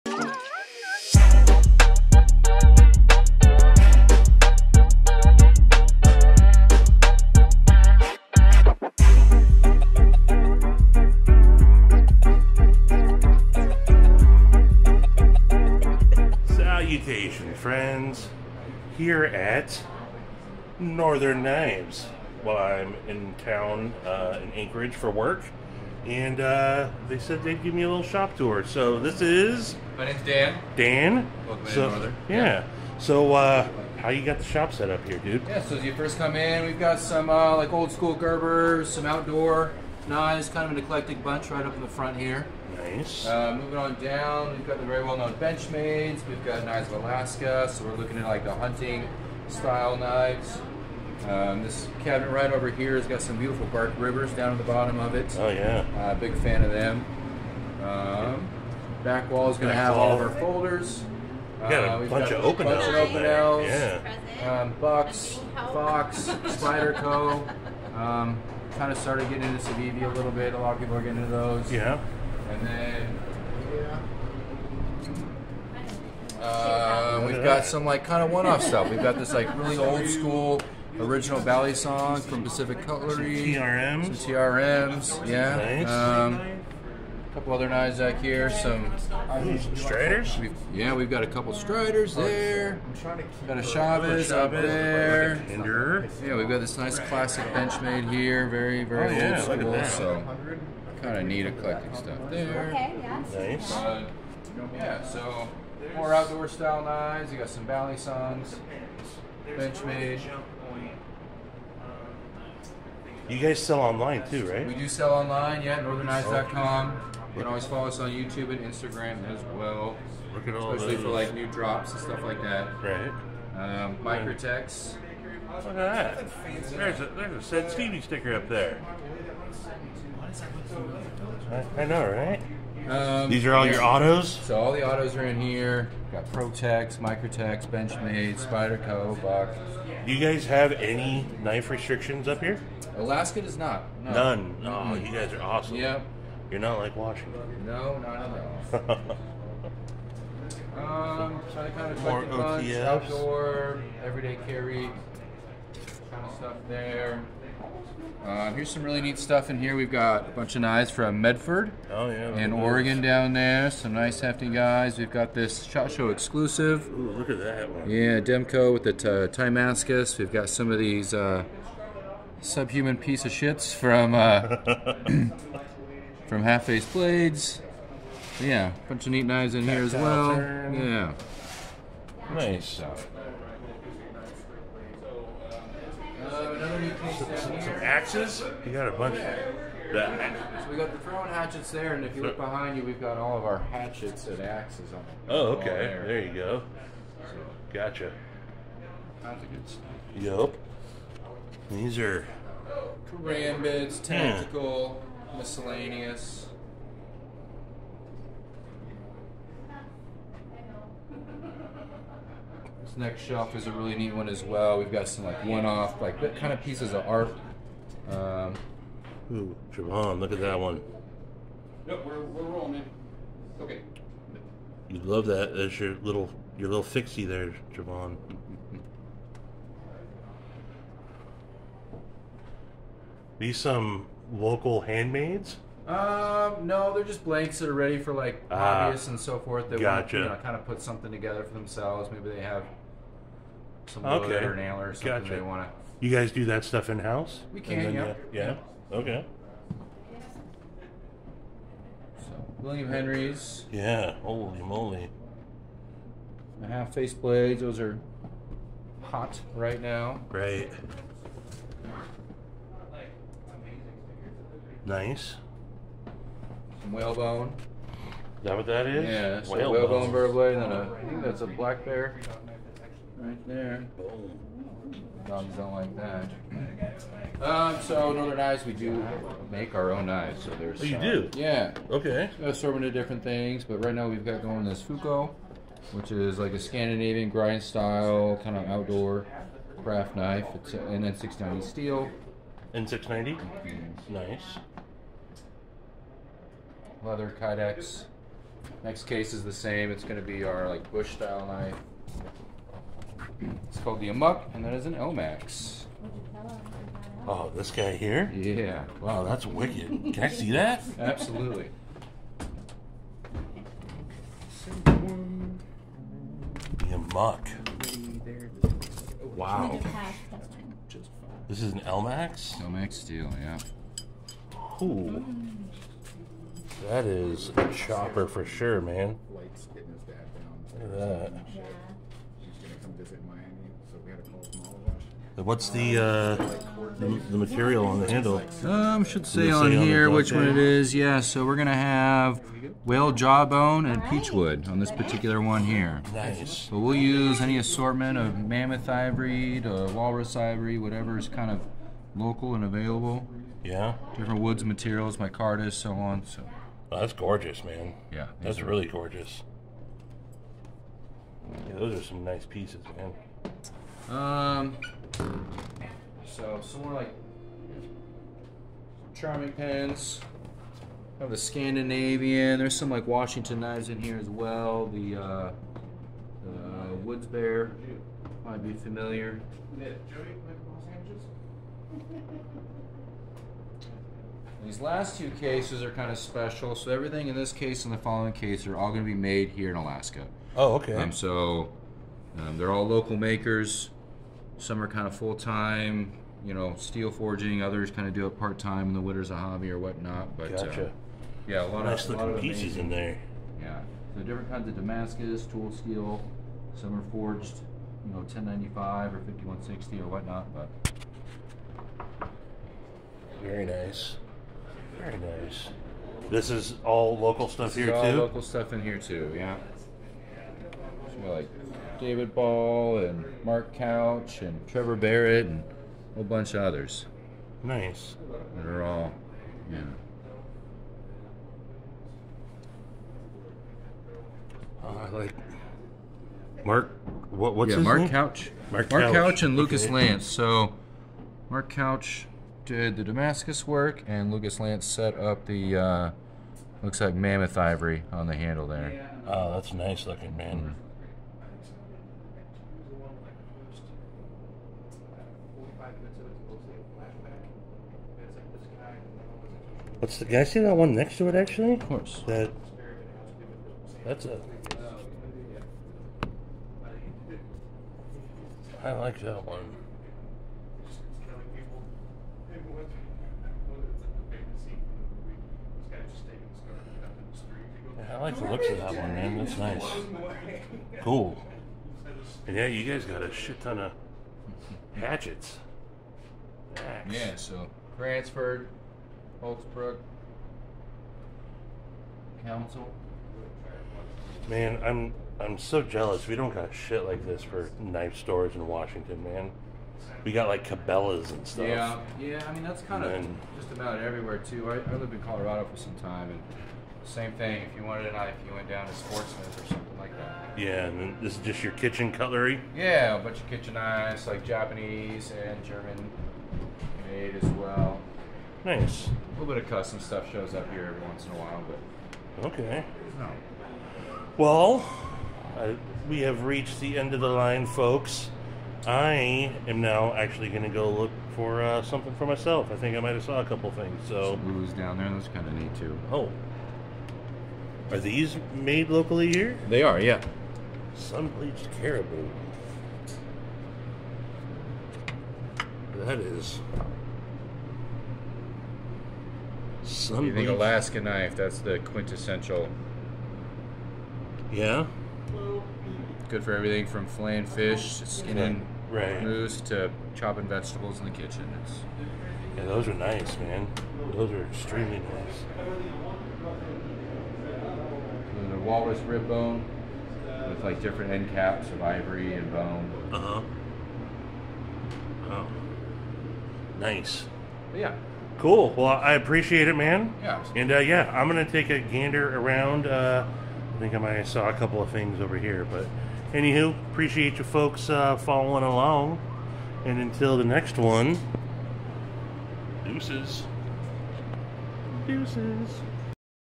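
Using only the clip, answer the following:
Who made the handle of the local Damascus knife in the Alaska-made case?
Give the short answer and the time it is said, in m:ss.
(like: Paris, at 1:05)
Lucas Lance, at 7:24.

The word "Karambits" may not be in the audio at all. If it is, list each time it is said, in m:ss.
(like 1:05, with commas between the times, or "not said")
3:23.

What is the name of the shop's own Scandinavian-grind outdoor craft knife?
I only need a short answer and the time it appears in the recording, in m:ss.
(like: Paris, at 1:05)
Fuko, at 4:44.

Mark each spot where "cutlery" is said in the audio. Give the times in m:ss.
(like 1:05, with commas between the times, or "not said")
1:22, 8:32.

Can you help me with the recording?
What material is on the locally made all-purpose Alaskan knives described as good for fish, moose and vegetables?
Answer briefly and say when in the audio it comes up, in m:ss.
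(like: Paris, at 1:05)
Sun bleached caribou, at 9:00.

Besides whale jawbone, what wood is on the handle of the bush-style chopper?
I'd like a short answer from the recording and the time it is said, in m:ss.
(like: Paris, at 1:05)
Peachwood, at 5:44.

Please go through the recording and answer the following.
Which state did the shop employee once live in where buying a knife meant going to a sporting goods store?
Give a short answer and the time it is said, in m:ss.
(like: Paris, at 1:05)
Colorado, at 8:25.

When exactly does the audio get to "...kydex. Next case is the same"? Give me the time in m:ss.
4:57.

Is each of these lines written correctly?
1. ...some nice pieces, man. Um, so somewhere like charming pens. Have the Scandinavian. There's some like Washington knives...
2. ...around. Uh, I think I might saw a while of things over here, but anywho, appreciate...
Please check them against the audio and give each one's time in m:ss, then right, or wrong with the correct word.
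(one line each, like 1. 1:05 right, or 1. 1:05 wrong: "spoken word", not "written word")
1. 6:02 right
2. 9:42 wrong: "couple", not "while".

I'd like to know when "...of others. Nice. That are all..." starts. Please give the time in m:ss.
7:06.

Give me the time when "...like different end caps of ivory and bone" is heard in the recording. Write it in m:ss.
9:30.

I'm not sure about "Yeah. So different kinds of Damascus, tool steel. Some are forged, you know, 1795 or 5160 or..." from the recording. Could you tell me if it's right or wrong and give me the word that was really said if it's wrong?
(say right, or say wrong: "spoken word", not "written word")
wrong: "1095", not "1795".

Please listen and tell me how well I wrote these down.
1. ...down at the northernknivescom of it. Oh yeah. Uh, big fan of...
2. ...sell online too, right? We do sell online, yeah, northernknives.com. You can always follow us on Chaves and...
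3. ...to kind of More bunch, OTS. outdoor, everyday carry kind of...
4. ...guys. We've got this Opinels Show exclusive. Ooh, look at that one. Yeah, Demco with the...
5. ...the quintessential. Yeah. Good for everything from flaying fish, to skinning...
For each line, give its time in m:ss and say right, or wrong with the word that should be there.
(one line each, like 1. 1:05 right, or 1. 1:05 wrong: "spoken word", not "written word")
1. 0:54 wrong: "bottom", not "northernknivescom"
2. 1:53 wrong: "YouTube", not "Chaves"
3. 2:31 right
4. 2:44 wrong: "Shot", not "Opinels"
5. 9:11 right.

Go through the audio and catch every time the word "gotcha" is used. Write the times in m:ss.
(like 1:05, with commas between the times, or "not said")
3:17, 3:59, 4:05, 6:40.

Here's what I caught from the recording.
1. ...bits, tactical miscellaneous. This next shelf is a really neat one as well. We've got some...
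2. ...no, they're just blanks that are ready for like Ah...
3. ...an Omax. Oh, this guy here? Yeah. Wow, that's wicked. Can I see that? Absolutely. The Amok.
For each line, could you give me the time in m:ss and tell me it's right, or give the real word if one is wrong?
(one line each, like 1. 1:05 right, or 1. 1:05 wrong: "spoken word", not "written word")
1. 3:23 right
2. 3:56 right
3. 5:04 right.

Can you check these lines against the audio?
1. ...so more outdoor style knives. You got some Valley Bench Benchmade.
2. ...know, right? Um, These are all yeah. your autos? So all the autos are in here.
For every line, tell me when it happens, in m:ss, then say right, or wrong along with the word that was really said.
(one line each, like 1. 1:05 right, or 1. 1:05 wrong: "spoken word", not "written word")
1. 1:45 right
2. 2:11 right.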